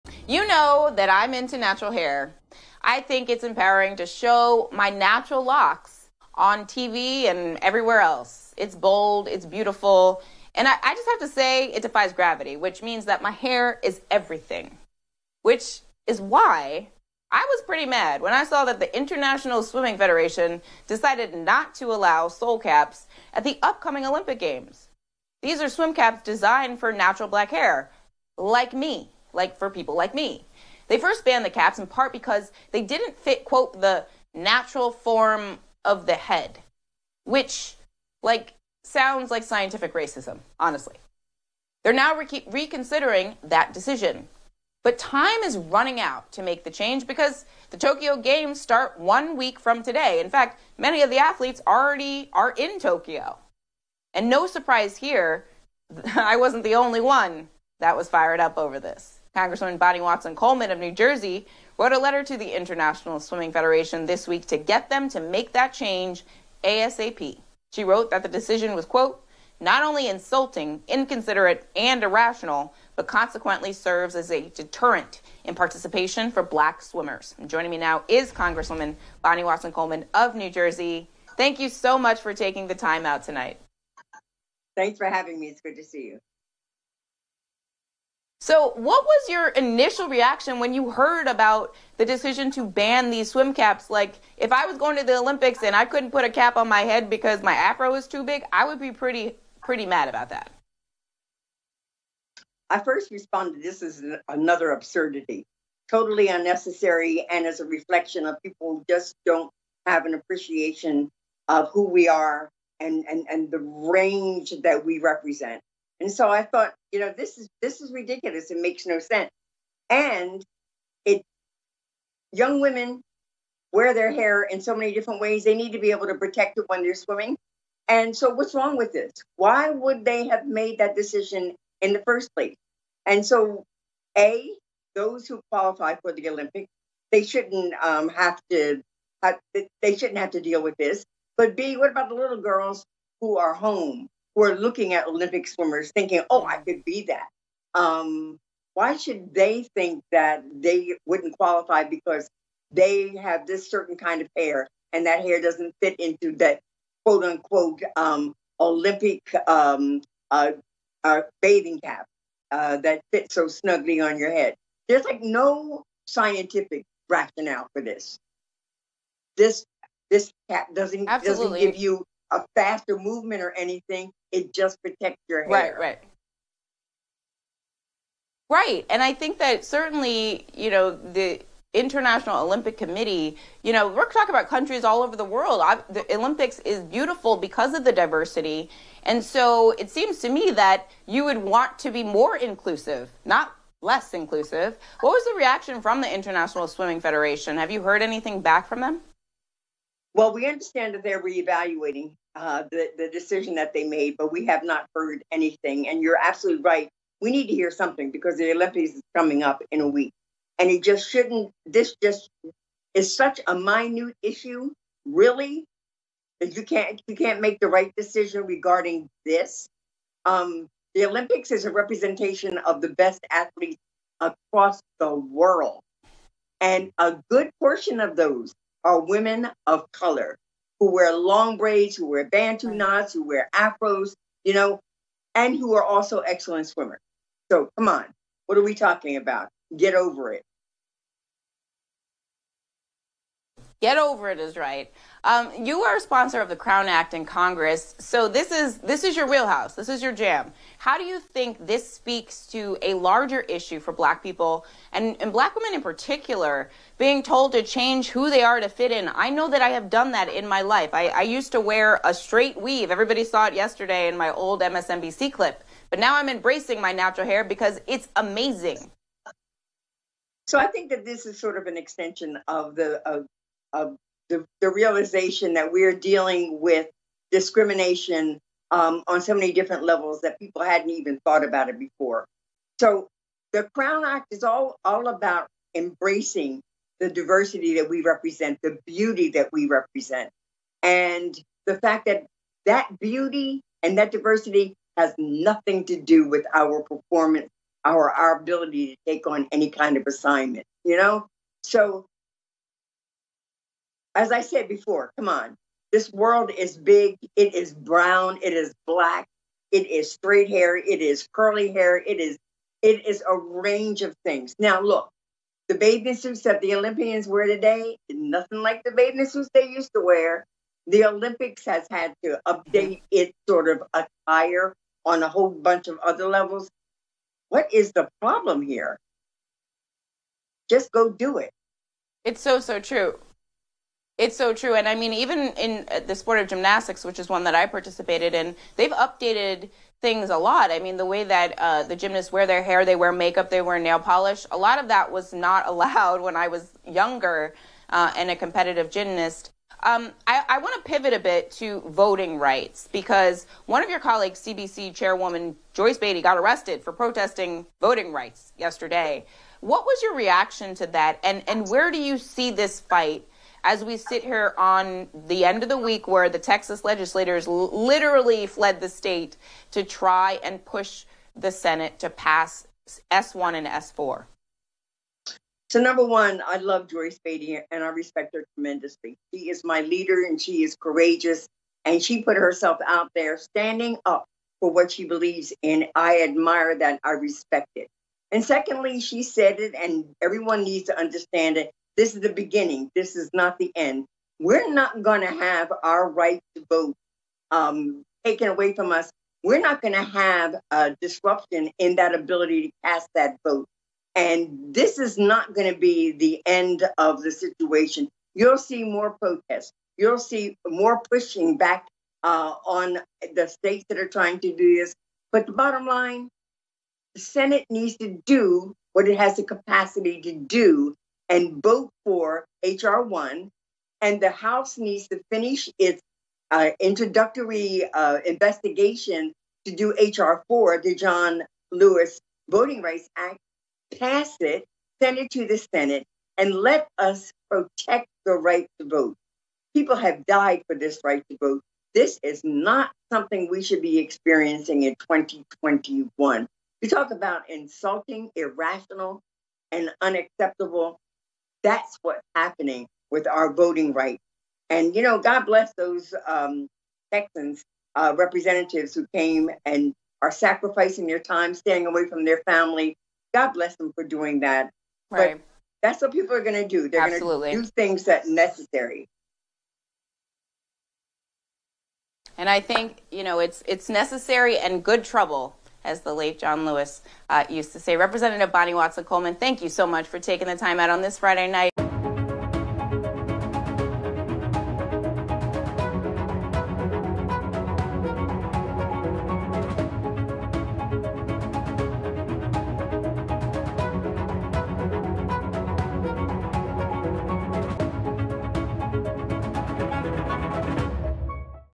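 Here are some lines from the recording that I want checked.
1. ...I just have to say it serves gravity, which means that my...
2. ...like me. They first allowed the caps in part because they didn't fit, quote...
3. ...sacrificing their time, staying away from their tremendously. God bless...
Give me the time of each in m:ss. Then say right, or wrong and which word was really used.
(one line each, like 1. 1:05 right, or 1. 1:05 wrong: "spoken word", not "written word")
1. 0:10 wrong: "defies", not "serves"
2. 0:29 wrong: "banned", not "allowed"
3. 7:40 wrong: "family", not "tremendously".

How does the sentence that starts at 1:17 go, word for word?
And joining me now is Congresswoman Bonnie Watson Coleman of New Jersey.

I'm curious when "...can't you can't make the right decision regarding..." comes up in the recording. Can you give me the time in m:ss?
3:36.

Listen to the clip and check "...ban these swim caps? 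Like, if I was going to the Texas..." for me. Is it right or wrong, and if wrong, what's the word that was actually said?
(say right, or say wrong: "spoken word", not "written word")
wrong: "Olympics", not "Texas".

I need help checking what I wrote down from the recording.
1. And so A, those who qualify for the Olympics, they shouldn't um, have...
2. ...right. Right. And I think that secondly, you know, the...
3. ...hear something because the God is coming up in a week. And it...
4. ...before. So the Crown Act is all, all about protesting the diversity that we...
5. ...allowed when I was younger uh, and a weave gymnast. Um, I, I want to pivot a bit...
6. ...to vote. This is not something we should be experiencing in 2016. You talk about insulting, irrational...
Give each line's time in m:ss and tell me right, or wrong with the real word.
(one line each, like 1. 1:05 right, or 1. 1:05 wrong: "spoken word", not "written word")
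1. 2:13 right
2. 2:55 wrong: "certainly", not "secondly"
3. 3:27 wrong: "Olympics", not "God"
4. 4:41 wrong: "embracing", not "protesting"
5. 5:45 wrong: "competitive", not "weave"
6. 7:21 wrong: "2021", not "2016".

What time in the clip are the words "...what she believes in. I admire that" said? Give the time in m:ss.
6:24.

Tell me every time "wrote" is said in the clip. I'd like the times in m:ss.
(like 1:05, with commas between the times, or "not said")
1:01, 1:07.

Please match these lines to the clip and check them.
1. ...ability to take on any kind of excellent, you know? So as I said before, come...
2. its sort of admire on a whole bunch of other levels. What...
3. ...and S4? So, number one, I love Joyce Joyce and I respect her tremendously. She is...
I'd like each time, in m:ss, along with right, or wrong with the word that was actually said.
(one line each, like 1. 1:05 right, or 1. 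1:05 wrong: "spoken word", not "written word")
1. 4:58 wrong: "assignment", not "excellent"
2. 5:23 wrong: "attire", not "admire"
3. 6:13 wrong: "Beatty", not "Joyce".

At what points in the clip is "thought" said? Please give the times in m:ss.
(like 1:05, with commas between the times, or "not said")
1:56, 4:41.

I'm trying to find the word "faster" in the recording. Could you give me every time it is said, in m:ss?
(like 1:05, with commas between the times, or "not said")
2:52.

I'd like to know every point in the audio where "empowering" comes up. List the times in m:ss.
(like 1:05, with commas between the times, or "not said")
0:03.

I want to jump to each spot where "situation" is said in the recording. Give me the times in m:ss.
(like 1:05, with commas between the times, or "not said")
6:47.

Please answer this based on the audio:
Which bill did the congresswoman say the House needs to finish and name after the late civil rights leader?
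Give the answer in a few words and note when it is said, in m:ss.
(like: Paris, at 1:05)
HR 4, at 7:09.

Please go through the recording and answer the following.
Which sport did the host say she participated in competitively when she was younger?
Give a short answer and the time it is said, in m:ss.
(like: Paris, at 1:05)
Gymnastics, at 5:36.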